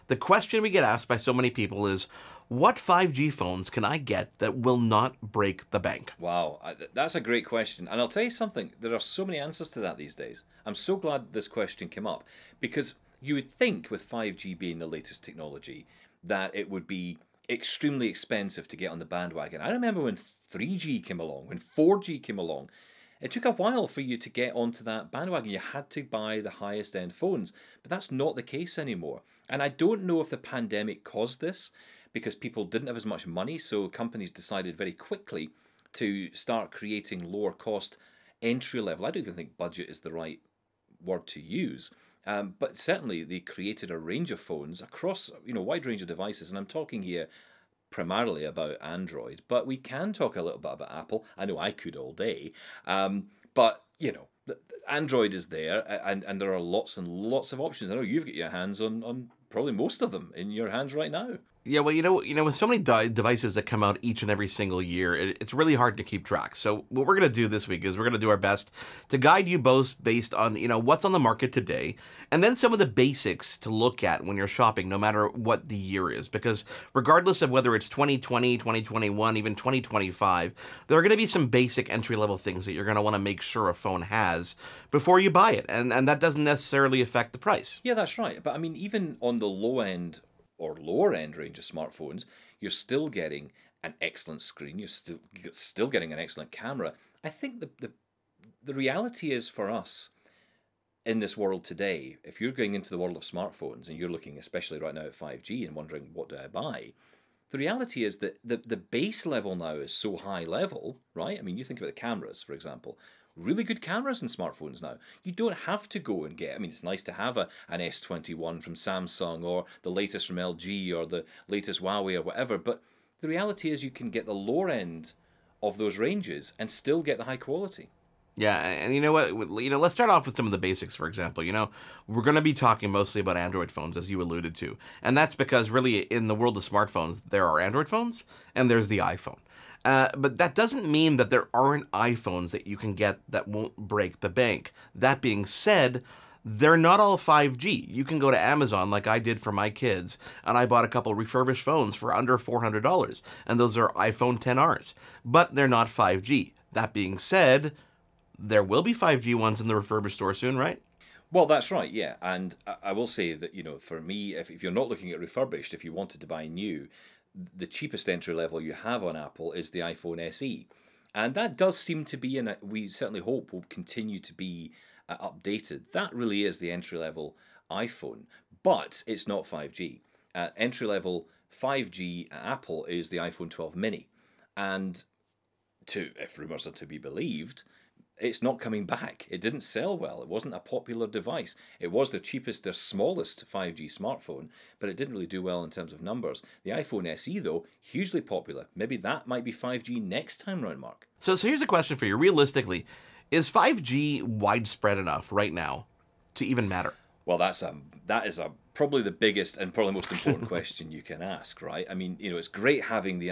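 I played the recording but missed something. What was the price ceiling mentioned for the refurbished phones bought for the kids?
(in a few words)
$400.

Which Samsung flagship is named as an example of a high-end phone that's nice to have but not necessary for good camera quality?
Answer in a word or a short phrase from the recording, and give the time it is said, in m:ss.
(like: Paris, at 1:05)
S21, at 1:57.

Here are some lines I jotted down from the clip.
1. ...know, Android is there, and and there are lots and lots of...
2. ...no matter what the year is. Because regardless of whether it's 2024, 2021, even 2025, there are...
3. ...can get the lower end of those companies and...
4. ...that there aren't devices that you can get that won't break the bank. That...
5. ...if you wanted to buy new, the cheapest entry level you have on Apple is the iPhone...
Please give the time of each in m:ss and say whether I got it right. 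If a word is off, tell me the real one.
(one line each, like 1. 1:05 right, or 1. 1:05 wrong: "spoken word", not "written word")
1. 0:54 right
2. 1:14 wrong: "2020", not "2024"
3. 2:03 wrong: "ranges", not "companies"
4. 2:21 wrong: "iPhones", not "devices"
5. 2:45 right.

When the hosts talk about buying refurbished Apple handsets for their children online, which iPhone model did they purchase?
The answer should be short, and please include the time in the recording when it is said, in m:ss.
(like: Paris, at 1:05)
iPhone 10R, at 2:33.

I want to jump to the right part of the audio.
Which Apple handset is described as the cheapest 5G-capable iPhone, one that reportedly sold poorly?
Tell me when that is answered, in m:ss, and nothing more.
3:03.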